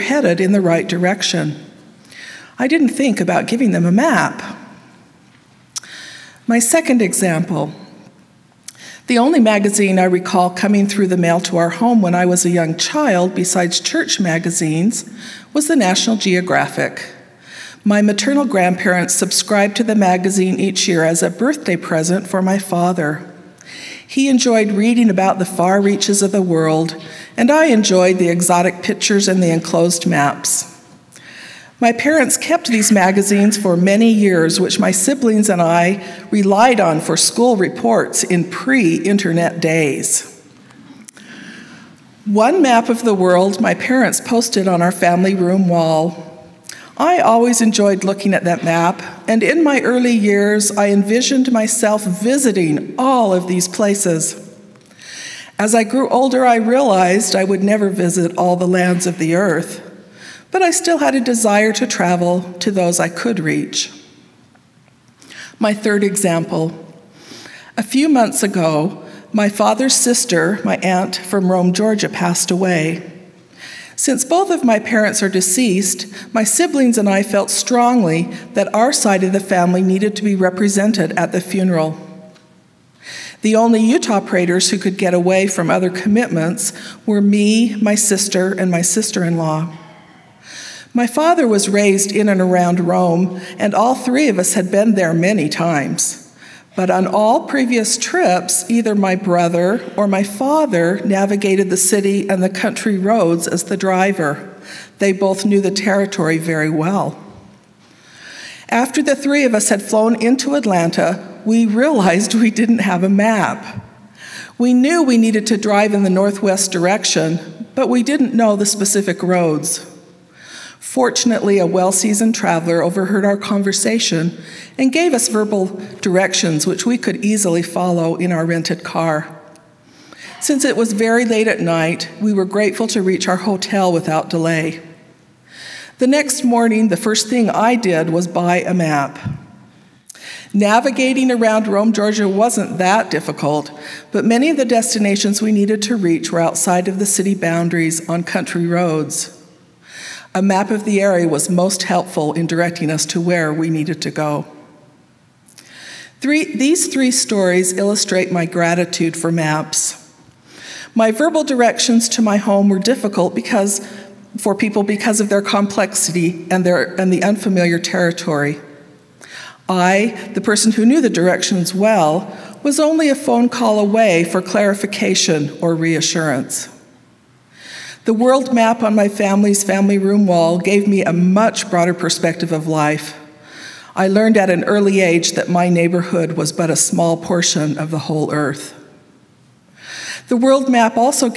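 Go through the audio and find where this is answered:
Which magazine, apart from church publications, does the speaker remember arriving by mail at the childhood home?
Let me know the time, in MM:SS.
00:15.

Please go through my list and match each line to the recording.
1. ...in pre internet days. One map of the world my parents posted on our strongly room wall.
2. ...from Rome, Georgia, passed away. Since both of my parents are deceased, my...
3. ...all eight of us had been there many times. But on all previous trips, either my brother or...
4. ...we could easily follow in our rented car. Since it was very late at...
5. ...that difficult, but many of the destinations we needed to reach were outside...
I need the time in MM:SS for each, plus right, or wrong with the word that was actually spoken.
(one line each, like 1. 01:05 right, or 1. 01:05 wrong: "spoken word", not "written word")
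1. 00:38 wrong: "family", not "strongly"
2. 01:11 right
3. 01:33 wrong: "three", not "eight"
4. 02:06 right
5. 02:22 right.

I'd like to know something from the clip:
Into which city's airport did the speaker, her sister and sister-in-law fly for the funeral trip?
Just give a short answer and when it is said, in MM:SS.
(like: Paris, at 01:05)
Atlanta, at 01:50.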